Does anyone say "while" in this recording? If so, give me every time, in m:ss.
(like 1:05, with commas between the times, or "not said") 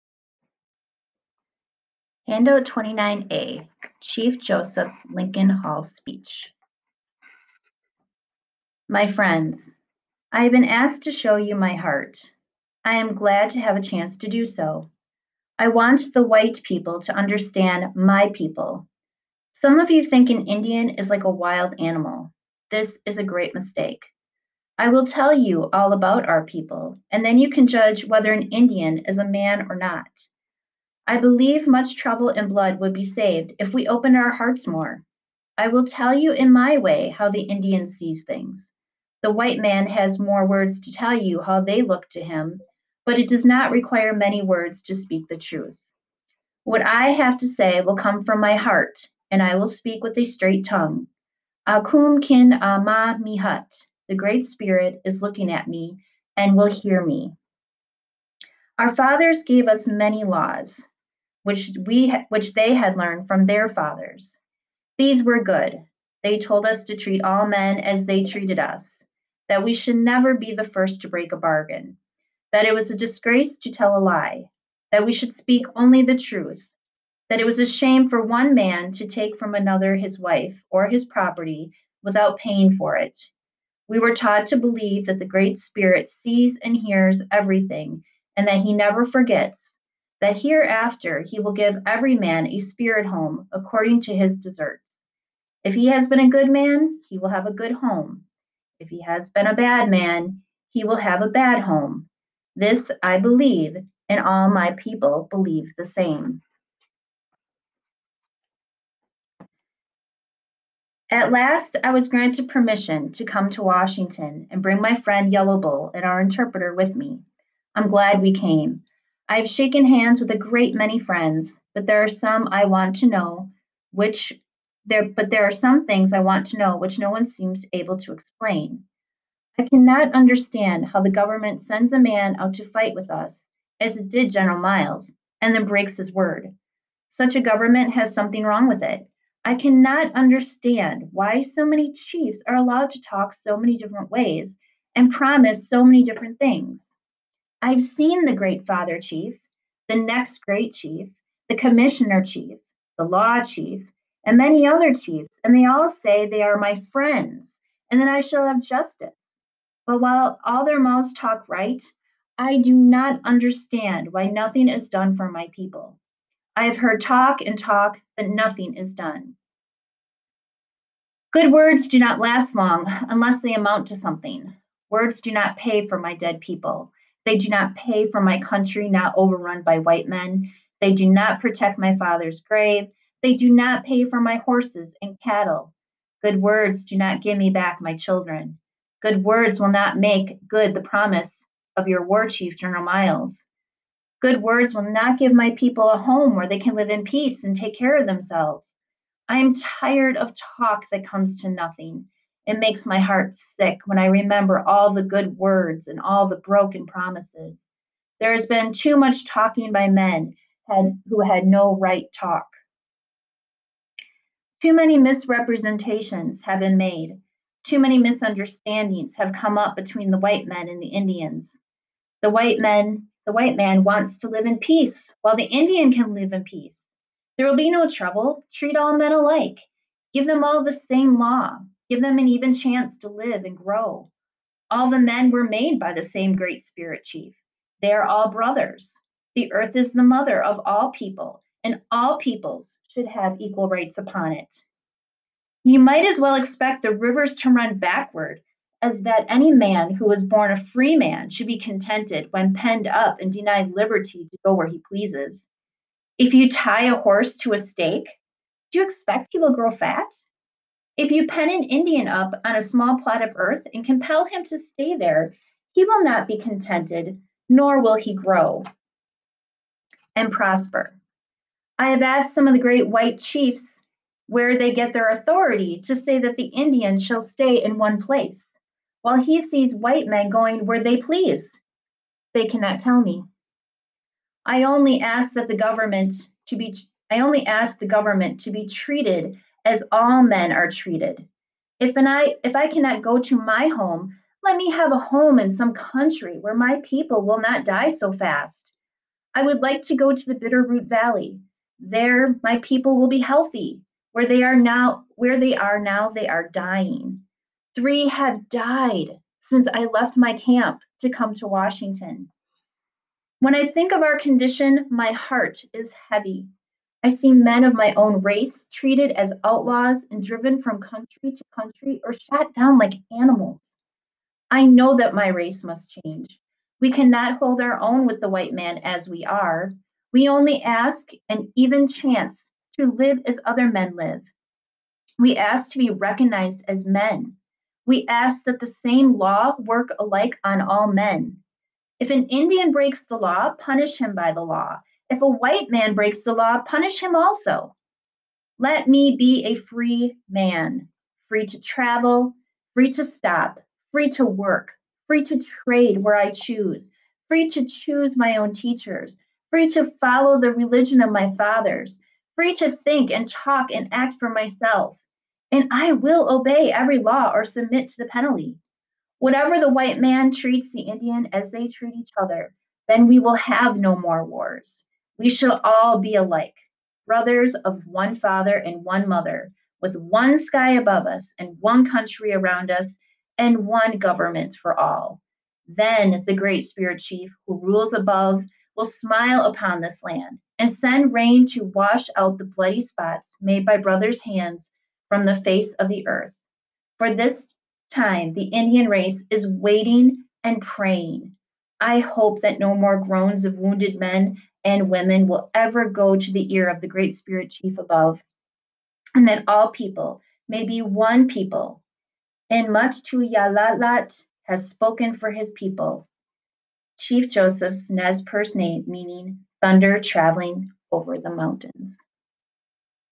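2:40, 3:45, 4:39.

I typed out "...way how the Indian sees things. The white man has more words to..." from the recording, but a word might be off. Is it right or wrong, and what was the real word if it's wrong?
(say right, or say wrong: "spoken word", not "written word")
right.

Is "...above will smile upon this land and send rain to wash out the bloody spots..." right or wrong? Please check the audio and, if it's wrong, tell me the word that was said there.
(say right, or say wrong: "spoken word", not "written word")
right.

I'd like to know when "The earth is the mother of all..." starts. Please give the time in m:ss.
3:59.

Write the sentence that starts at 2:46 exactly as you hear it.
I have heard talk and talk, but nothing is done.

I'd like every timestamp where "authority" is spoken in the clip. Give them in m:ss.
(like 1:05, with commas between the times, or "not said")
4:35.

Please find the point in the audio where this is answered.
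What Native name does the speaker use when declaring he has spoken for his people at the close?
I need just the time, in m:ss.
6:52.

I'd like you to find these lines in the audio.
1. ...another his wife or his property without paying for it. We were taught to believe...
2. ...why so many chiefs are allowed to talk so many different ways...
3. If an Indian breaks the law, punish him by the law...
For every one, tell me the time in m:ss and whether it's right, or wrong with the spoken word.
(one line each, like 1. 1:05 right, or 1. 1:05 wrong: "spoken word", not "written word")
1. 1:19 right
2. 2:21 right
3. 5:41 right.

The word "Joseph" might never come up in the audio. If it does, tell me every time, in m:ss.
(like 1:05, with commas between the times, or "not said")
0:04, 6:57.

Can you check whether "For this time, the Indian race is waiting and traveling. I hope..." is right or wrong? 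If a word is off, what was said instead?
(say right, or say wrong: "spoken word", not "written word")
wrong: "praying", not "traveling".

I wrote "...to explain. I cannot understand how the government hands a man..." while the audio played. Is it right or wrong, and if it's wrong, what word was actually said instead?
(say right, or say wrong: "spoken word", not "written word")
wrong: "sends", not "hands".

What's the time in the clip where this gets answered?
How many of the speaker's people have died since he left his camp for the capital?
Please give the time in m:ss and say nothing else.
5:07.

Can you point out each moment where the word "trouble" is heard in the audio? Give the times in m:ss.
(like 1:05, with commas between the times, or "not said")
0:31, 3:47.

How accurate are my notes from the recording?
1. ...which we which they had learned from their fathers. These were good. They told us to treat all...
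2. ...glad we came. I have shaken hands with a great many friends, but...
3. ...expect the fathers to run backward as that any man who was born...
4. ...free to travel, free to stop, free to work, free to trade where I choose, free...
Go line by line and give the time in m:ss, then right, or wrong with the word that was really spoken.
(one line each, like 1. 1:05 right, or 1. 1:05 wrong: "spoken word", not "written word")
1. 1:01 right
2. 1:57 right
3. 4:06 wrong: "rivers", not "fathers"
4. 5:51 right.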